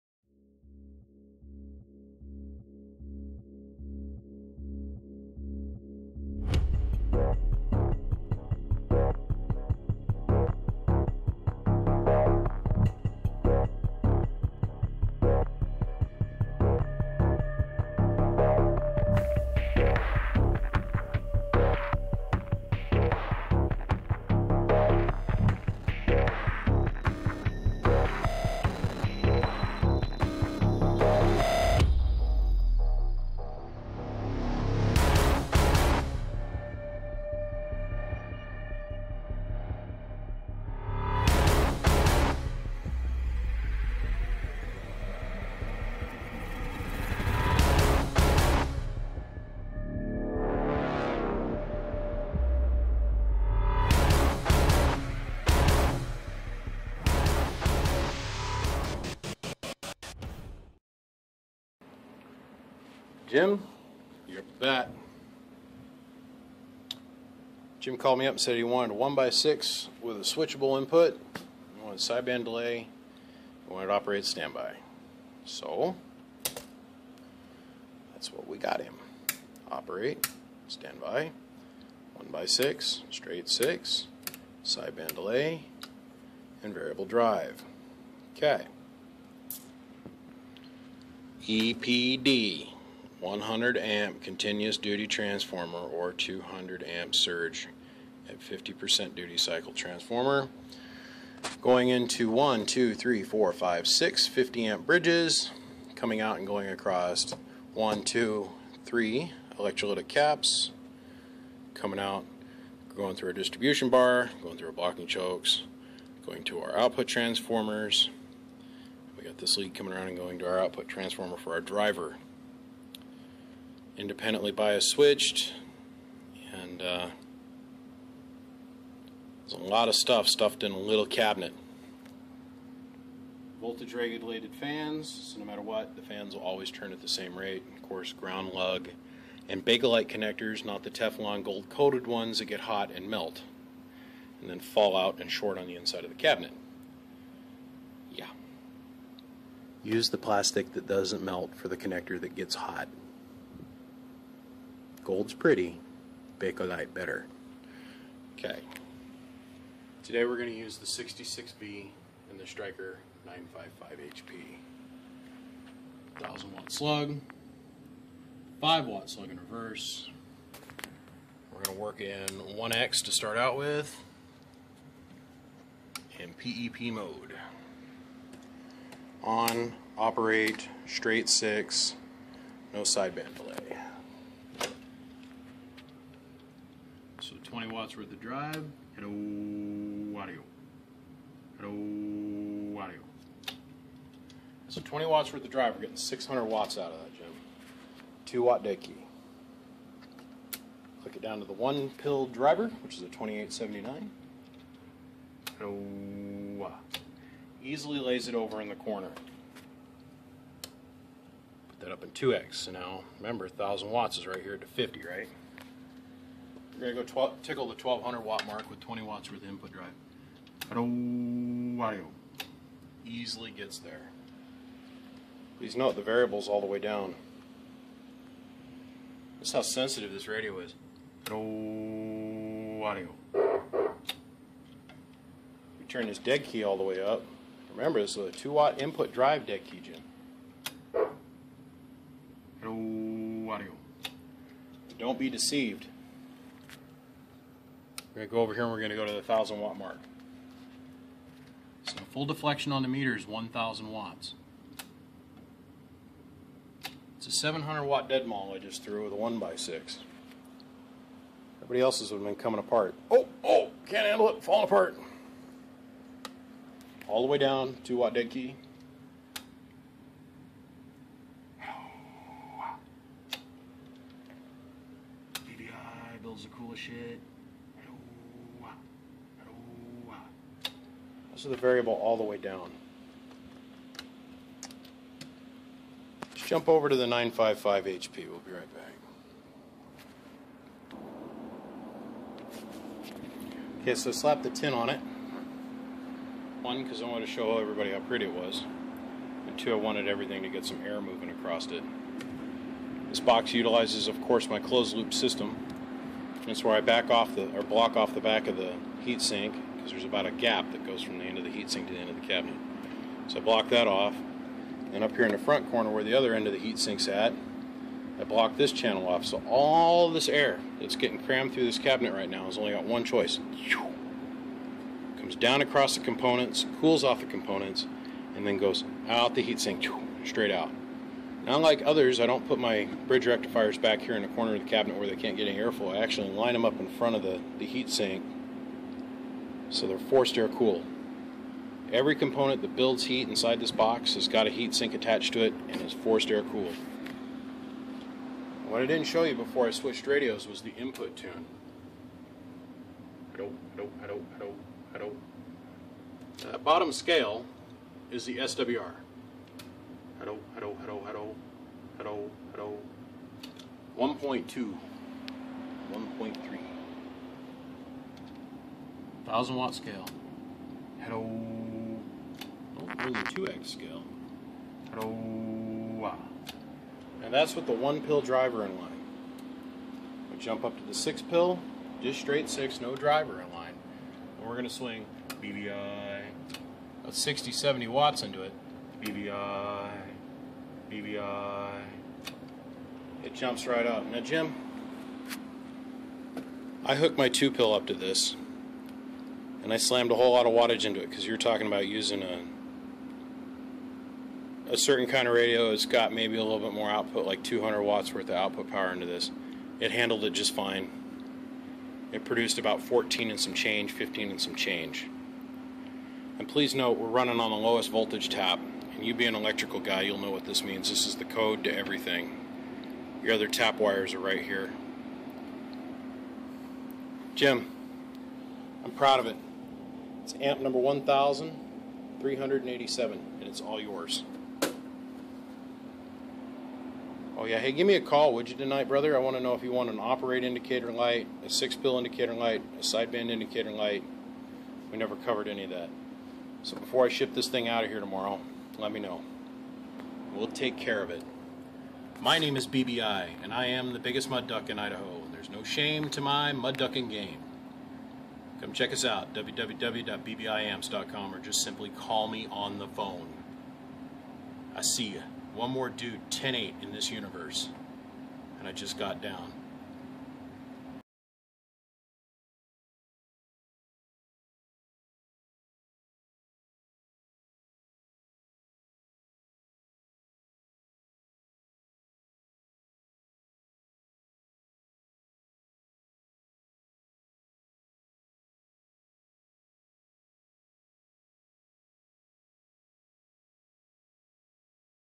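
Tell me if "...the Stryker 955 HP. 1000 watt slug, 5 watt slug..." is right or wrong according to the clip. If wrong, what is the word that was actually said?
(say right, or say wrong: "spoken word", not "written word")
right.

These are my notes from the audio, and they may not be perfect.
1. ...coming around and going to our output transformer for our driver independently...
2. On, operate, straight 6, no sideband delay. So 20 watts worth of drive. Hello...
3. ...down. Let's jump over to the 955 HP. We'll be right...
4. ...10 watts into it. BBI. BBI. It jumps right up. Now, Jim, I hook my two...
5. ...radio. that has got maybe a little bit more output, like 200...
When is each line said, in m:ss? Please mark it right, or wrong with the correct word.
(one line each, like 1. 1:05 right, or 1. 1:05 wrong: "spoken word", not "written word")
1. 1:59 right
2. 2:59 right
3. 4:42 right
4. 6:27 wrong: "70", not "10"
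5. 6:45 right.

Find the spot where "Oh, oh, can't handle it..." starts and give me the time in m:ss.
4:23.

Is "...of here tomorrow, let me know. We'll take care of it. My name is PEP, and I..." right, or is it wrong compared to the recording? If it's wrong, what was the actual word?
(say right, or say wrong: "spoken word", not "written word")
wrong: "BBI", not "PEP".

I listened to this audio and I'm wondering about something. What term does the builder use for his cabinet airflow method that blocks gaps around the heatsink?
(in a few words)
closed loop system.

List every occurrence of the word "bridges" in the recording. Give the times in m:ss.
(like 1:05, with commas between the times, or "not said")
1:44, 5:33.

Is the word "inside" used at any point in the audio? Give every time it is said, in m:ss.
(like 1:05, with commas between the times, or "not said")
2:25, 5:43.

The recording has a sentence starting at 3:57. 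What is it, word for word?
Remember, this is a 2 watt input drive dead key, Jim.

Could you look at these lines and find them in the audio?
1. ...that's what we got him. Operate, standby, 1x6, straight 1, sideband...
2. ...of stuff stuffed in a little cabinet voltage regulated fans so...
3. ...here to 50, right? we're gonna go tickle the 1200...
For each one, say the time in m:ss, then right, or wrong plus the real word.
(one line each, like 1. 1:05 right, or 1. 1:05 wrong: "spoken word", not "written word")
1. 1:18 wrong: "6", not "1"
2. 2:09 right
3. 3:34 right.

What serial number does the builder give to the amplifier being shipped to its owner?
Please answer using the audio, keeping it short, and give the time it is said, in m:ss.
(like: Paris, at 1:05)
1387, at 7:10.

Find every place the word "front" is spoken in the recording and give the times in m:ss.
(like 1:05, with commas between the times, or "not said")
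5:15, 5:36.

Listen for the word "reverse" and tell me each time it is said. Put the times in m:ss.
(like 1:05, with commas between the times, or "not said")
2:49.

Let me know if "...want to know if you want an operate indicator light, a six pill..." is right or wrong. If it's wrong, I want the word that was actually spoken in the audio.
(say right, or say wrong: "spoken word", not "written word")
right.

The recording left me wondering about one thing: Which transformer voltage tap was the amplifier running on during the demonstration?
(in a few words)
lowest voltage tap.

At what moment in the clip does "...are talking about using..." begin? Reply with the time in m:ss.
6:41.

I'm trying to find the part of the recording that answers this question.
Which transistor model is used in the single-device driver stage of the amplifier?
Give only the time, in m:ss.
3:23.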